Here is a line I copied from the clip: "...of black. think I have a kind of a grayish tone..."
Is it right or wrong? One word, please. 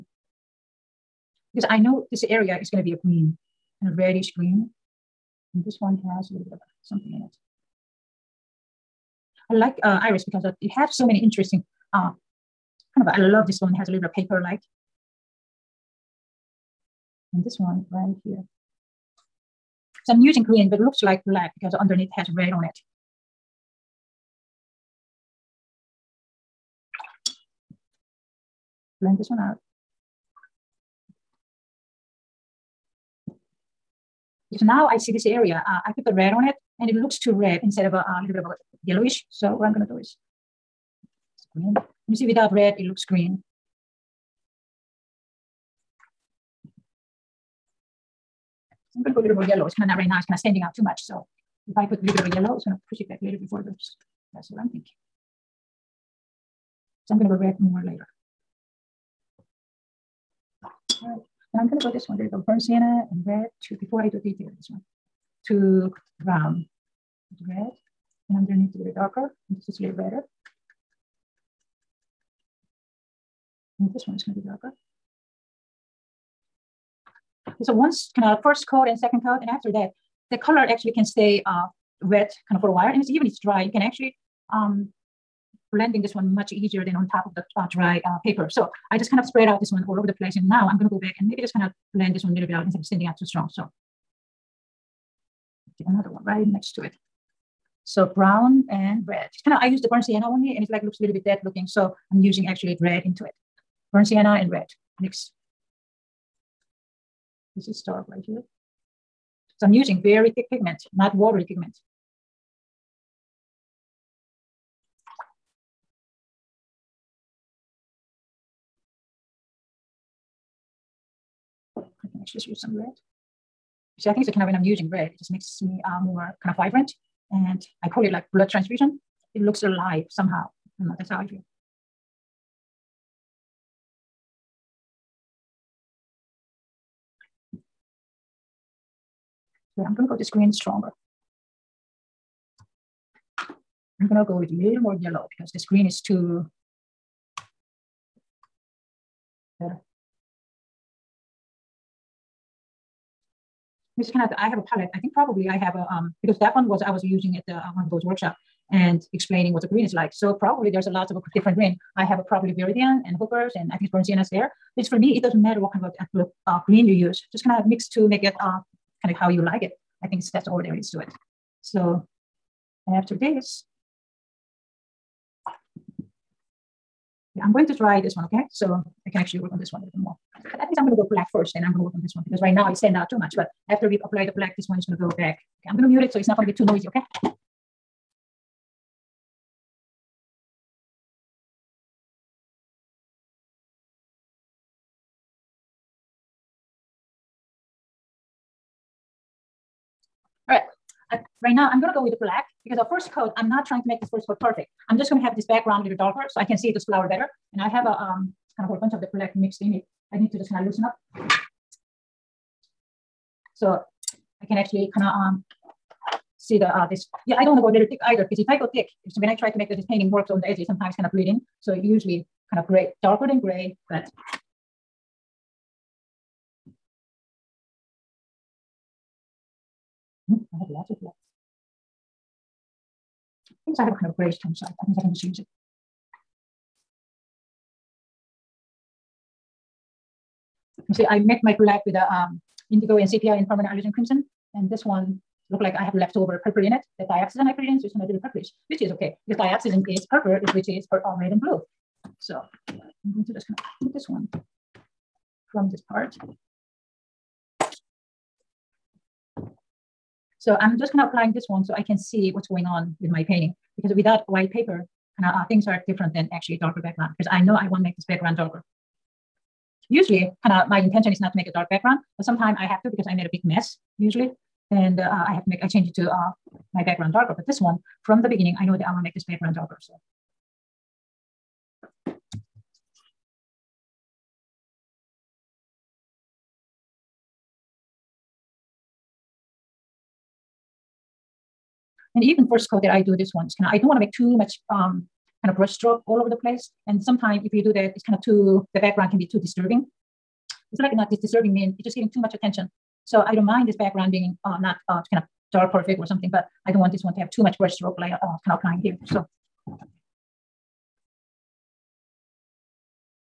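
right.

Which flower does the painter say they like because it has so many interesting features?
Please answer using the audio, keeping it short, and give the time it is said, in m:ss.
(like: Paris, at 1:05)
iris, at 0:10.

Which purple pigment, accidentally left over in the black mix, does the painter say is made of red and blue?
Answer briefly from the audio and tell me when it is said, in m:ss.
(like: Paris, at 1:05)
dioxazine, at 4:09.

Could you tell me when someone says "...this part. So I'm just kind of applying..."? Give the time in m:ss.
4:15.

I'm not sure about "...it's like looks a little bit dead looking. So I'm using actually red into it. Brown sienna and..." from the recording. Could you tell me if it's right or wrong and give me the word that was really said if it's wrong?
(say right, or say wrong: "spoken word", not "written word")
right.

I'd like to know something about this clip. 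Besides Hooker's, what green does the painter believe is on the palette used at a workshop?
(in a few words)
Viridian.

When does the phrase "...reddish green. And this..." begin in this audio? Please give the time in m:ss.
0:03.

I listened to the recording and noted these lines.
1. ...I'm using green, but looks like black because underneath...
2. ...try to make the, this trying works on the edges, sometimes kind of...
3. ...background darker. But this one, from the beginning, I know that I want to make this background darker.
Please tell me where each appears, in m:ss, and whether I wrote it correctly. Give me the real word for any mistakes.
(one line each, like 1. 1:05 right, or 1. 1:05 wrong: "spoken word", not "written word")
1. 0:20 right
2. 3:39 wrong: "painting", not "trying"
3. 4:36 right.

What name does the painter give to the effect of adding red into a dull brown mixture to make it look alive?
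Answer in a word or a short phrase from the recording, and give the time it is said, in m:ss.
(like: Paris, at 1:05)
blood transfusion, at 2:08.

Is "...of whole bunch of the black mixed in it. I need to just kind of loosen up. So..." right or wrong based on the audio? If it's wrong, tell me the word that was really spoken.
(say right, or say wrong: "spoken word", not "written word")
right.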